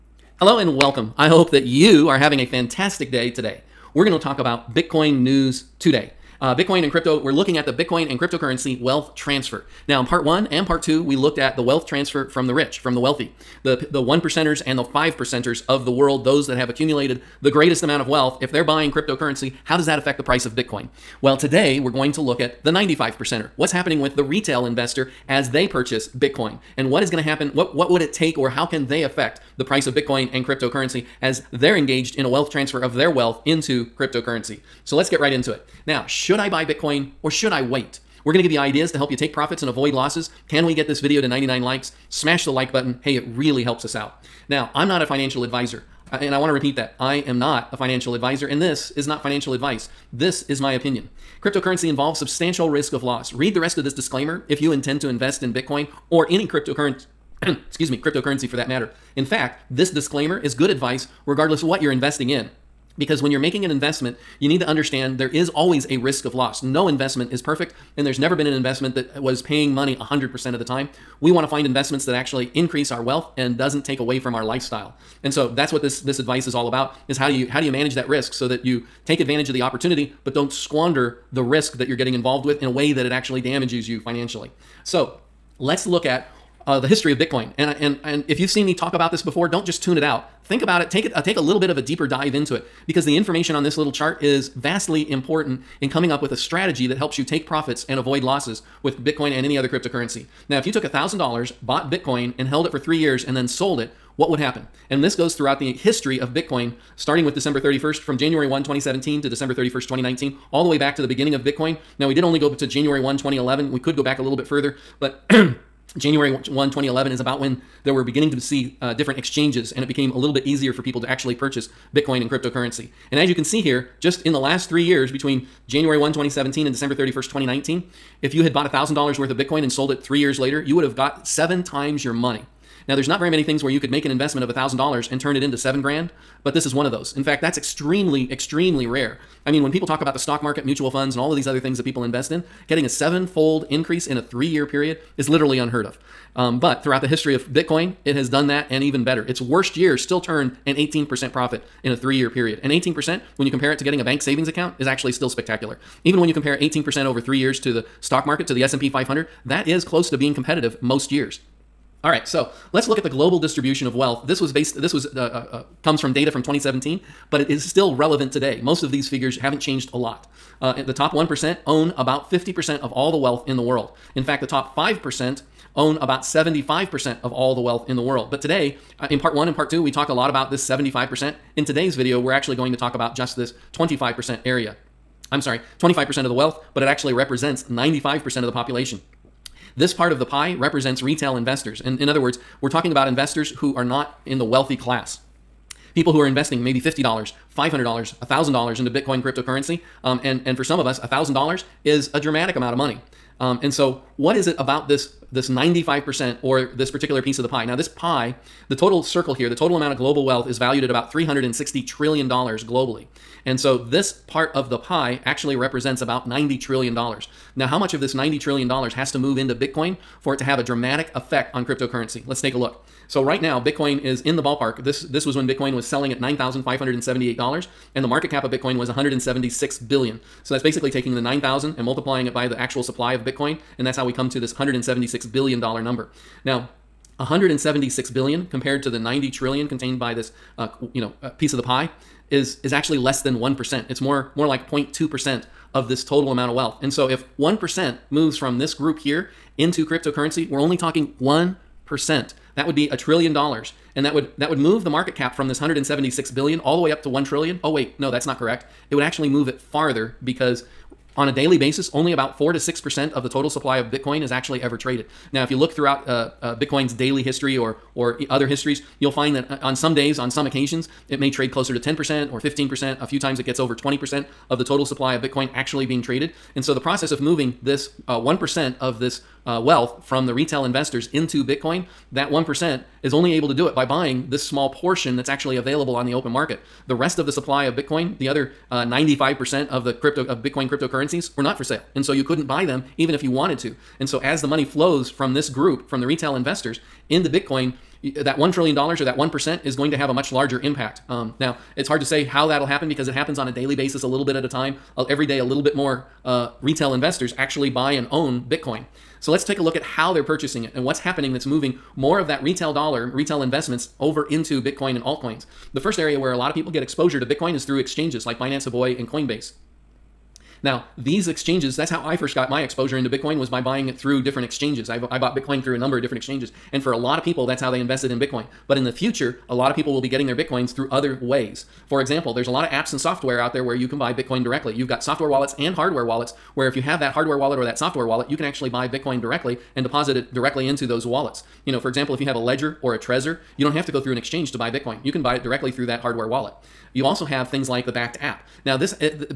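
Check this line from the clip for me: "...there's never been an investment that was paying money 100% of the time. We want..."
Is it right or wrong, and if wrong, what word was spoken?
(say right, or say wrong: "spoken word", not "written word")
right.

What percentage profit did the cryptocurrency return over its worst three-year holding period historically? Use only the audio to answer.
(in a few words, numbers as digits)
18%.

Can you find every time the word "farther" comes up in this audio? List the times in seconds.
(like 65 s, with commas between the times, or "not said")
259 s.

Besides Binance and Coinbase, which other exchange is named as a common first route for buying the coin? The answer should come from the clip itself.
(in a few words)
Huobi.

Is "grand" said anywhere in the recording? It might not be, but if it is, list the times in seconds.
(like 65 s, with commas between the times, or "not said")
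135 s.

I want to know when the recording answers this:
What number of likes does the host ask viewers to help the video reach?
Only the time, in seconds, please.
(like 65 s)
41 s.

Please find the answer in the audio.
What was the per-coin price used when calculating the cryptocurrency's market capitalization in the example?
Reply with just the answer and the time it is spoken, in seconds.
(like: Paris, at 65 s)
$9,578, at 226 s.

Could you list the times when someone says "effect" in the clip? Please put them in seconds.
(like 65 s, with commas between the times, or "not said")
221 s.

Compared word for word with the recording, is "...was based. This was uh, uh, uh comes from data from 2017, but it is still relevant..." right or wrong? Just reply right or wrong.
right.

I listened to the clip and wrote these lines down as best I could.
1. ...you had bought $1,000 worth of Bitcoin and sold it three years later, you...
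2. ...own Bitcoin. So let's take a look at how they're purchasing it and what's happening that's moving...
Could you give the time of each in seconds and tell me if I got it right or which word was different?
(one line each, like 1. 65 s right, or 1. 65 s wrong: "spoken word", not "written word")
1. 128 s right
2. 308 s right.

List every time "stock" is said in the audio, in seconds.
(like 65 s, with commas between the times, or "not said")
140 s, 157 s.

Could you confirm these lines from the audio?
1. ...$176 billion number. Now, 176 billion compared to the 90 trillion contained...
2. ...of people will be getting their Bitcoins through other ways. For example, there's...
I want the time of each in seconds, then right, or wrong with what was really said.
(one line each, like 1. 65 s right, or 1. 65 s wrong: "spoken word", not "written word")
1. 234 s right
2. 329 s right.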